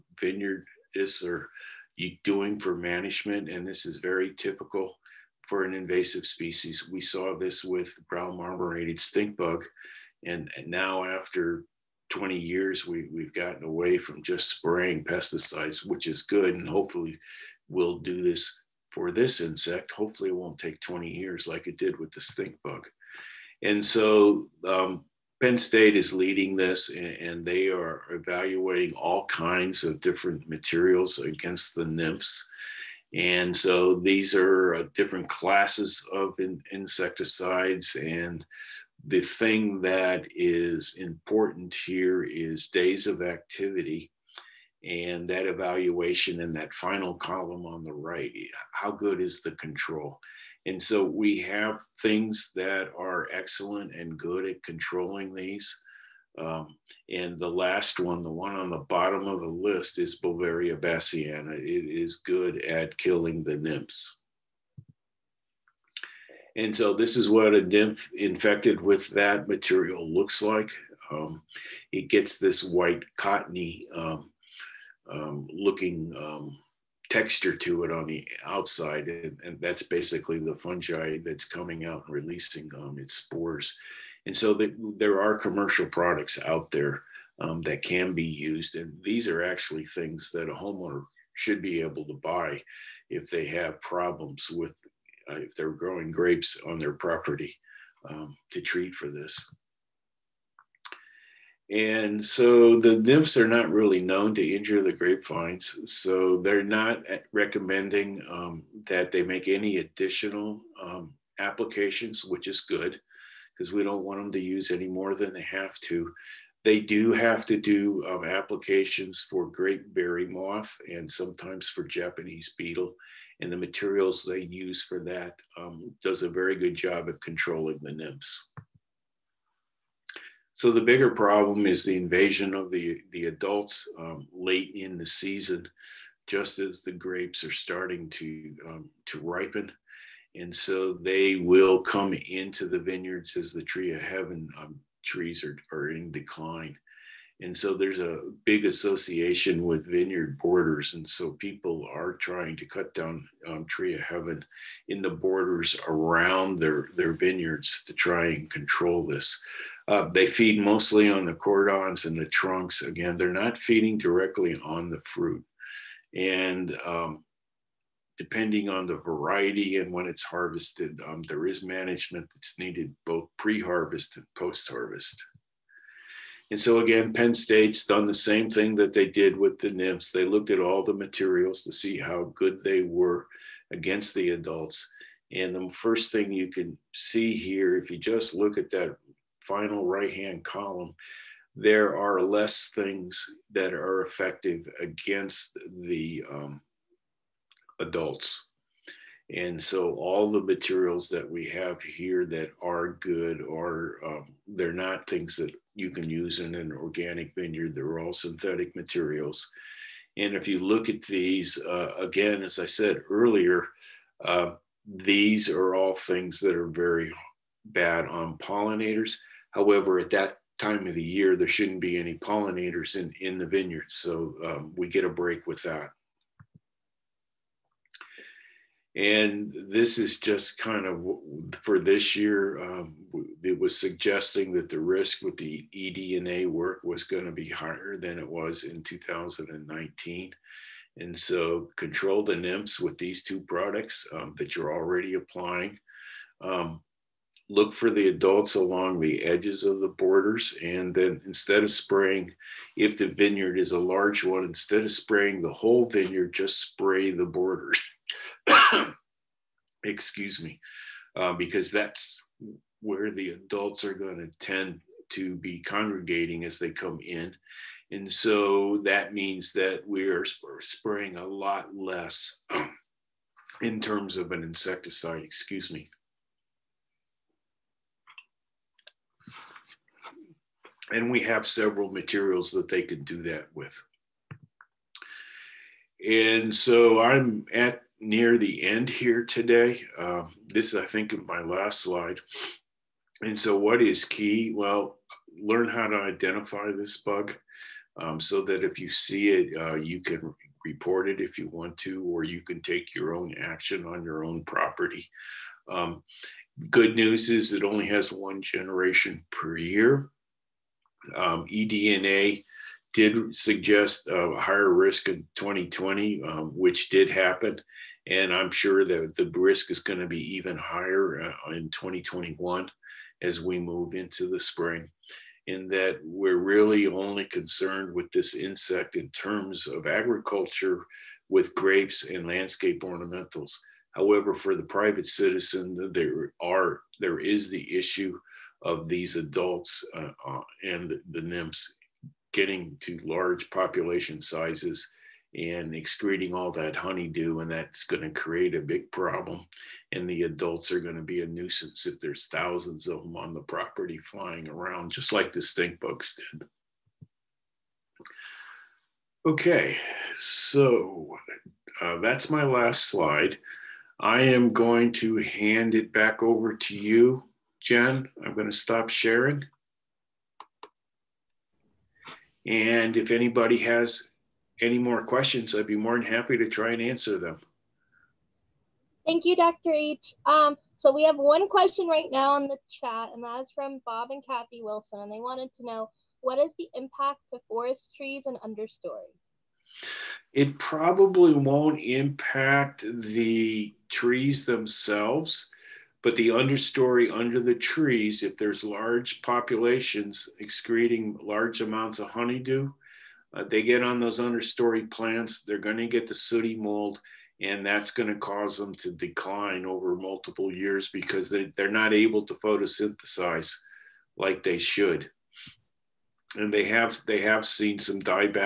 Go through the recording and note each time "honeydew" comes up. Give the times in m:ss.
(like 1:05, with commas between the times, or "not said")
5:46, 6:42.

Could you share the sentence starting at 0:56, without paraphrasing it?
Um, and the last one, the one on the bottom of the list, is Beauveria bassiana.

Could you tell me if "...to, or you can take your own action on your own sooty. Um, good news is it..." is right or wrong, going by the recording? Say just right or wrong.
wrong.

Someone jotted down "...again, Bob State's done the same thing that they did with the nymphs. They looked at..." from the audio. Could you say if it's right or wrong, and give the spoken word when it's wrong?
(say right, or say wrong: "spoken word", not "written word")
wrong: "Penn", not "Bob".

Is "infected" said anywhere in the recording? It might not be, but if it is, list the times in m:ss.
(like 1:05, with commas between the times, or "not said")
1:08.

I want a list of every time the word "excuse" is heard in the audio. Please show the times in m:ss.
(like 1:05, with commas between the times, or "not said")
4:19, 4:35.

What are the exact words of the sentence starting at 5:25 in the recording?
In that we're really only concerned with this insect in terms of agriculture with grapes and landscape ornamentals.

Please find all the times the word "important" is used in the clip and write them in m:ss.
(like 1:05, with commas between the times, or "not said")
0:40.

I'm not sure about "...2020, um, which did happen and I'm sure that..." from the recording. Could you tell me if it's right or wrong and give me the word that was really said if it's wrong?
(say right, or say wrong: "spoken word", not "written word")
right.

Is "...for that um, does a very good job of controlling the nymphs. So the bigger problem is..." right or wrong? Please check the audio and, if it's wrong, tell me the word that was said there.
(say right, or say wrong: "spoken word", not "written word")
right.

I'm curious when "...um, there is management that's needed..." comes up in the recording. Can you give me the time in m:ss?
2:51.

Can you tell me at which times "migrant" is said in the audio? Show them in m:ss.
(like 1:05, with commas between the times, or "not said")
not said.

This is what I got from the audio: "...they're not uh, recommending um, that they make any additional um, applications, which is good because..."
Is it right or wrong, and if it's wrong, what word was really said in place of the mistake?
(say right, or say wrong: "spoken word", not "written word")
right.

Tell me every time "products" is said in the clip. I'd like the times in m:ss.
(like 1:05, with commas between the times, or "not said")
1:25, 4:03.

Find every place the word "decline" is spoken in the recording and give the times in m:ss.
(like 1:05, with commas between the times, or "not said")
2:26, 6:48.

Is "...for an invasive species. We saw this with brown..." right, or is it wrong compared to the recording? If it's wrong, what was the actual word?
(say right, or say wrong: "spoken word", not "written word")
right.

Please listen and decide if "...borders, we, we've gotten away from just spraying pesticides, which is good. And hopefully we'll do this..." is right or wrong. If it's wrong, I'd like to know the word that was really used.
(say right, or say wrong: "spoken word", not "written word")
wrong: "years", not "borders".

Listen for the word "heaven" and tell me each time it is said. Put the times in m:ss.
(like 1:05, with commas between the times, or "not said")
2:24, 2:33.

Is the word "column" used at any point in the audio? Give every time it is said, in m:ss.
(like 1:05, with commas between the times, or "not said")
0:47, 3:10.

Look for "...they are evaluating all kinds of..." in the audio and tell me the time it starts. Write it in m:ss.
0:27.